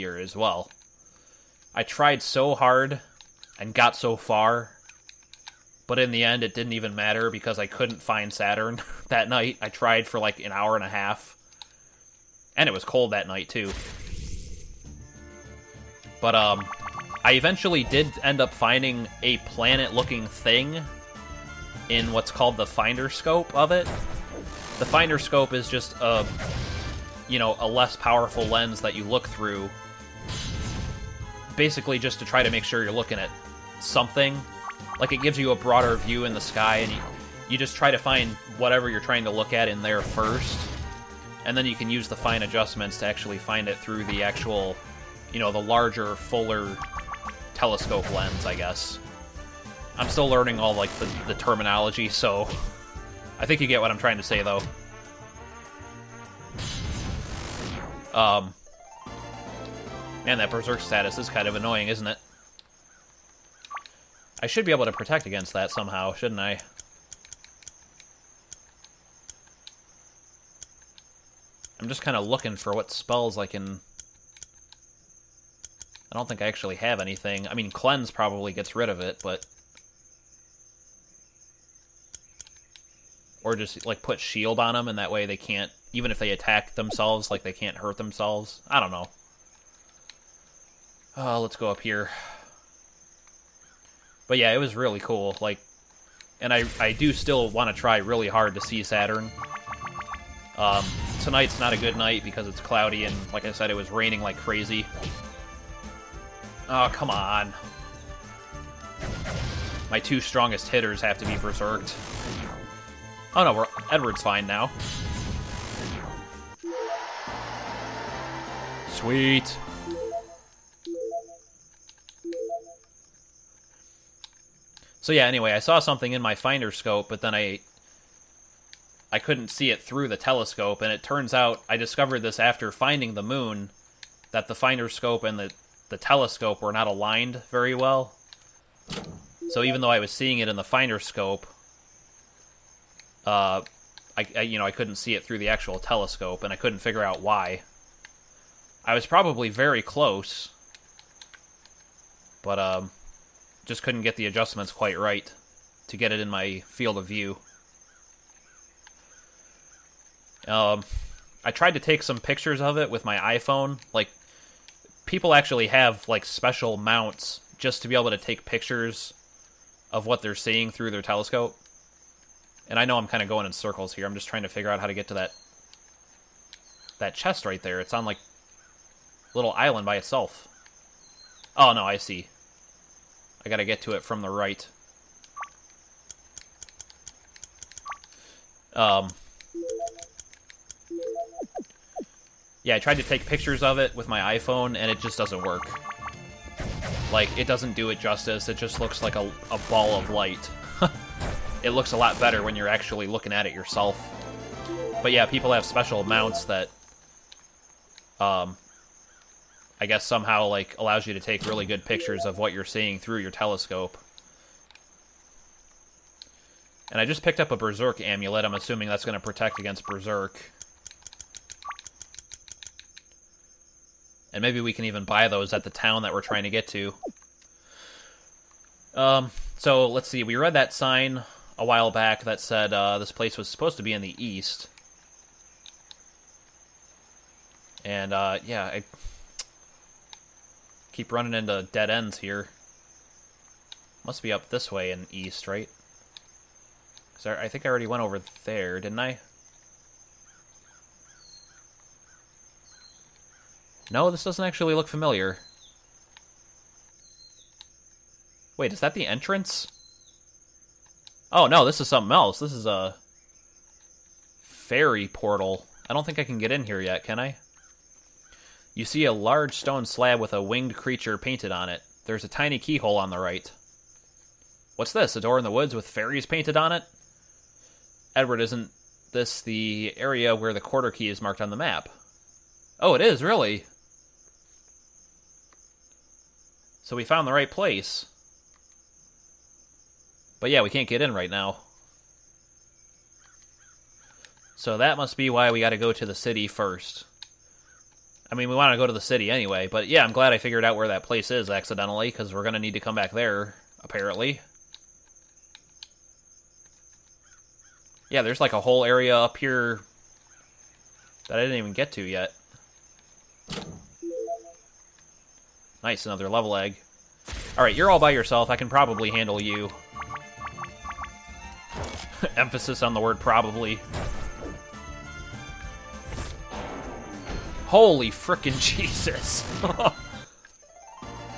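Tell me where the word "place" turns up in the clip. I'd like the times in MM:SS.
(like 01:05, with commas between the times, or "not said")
03:53, 04:47, 05:01.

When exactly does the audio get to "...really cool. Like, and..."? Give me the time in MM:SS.
01:34.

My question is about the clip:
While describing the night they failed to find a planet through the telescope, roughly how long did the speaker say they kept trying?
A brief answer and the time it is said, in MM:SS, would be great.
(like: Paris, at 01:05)
an hour and a half, at 00:10.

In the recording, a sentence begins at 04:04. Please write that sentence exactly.
Must be up this way and east, right?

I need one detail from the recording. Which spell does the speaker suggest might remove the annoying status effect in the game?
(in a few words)
Cleanse.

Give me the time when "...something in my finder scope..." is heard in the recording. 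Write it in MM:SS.
02:05.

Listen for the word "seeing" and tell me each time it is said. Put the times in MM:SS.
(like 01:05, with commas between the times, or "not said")
02:20, 02:50, 03:32.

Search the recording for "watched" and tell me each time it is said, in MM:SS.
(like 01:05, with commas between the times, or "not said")
not said.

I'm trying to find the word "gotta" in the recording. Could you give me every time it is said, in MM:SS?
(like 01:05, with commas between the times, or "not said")
03:03, 04:55.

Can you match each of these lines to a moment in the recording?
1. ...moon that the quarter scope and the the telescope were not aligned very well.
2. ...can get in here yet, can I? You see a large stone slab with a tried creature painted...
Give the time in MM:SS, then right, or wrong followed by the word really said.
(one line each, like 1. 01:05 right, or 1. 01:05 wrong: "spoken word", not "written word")
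1. 02:13 wrong: "finder", not "quarter"
2. 04:26 wrong: "winged", not "tried".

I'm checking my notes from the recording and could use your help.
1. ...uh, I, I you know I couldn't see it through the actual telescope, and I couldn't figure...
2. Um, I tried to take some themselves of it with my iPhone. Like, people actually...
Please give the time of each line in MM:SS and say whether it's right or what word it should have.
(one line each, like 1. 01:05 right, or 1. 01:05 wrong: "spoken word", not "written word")
1. 02:23 right
2. 02:40 wrong: "pictures", not "themselves".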